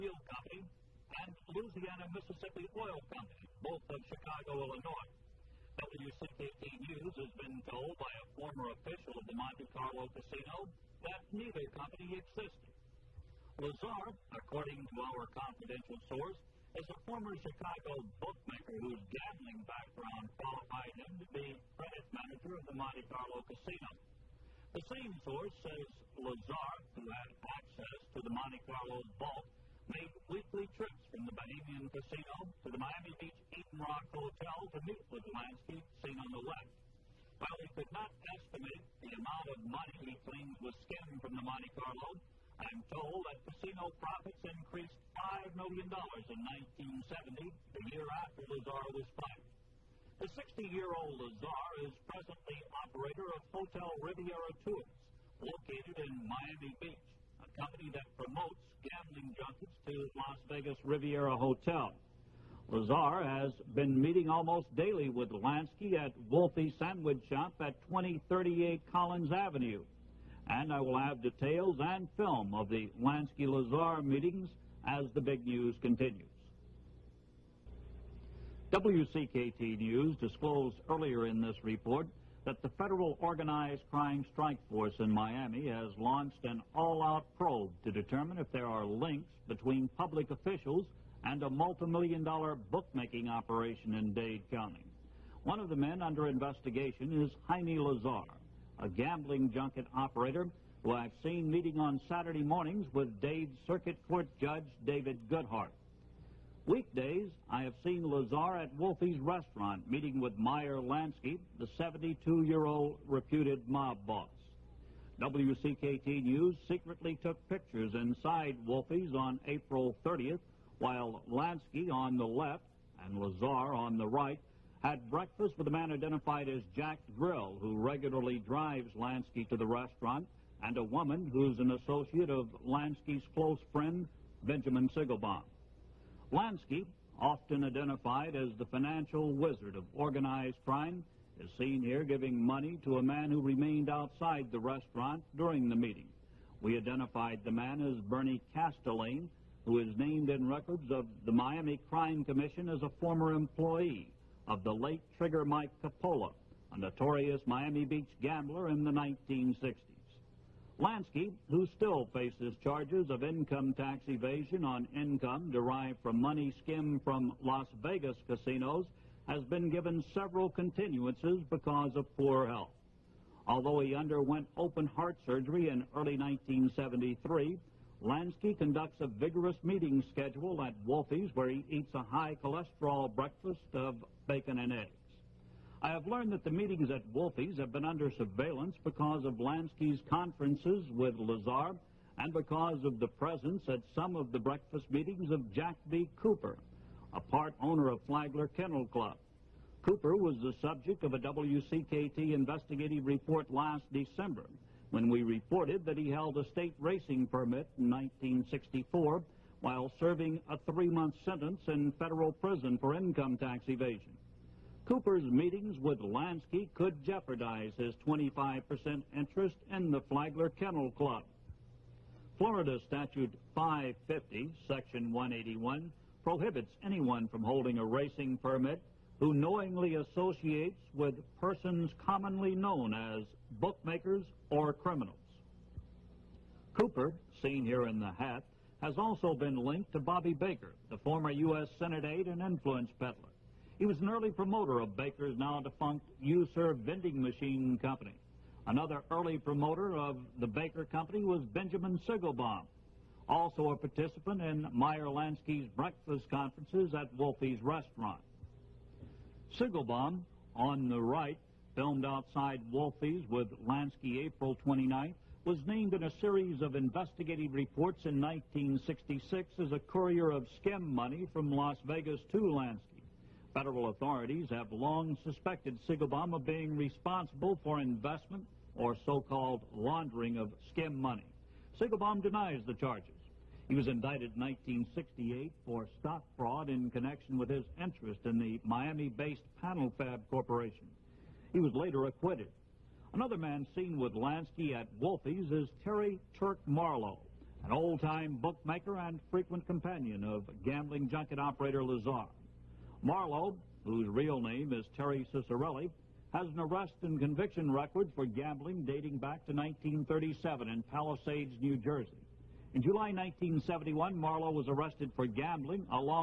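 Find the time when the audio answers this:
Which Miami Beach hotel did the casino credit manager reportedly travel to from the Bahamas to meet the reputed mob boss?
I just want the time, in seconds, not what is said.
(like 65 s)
33 s.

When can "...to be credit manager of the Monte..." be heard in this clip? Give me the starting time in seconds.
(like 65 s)
21 s.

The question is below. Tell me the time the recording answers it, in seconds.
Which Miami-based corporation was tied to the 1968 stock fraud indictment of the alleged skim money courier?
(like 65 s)
289 s.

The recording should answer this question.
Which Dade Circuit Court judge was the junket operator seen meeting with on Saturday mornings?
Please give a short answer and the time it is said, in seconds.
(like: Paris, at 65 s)
David Goodhart, at 104 s.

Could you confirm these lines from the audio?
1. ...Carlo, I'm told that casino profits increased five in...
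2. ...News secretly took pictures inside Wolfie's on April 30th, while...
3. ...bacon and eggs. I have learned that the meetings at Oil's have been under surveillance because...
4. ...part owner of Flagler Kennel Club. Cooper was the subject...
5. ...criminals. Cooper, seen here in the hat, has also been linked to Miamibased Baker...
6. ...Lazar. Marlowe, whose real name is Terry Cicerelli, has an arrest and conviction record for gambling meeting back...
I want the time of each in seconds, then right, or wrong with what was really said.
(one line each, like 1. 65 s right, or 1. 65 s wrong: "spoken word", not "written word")
1. 41 s right
2. 116 s right
3. 184 s wrong: "Wolfie", not "Oil"
4. 197 s right
5. 234 s wrong: "Bobby", not "Miamibased"
6. 301 s wrong: "dating", not "meeting".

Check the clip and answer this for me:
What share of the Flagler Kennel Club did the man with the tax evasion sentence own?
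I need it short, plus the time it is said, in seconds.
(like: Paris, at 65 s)
25%, at 218 s.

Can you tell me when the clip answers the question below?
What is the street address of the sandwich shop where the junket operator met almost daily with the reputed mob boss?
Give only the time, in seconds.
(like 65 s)
67 s.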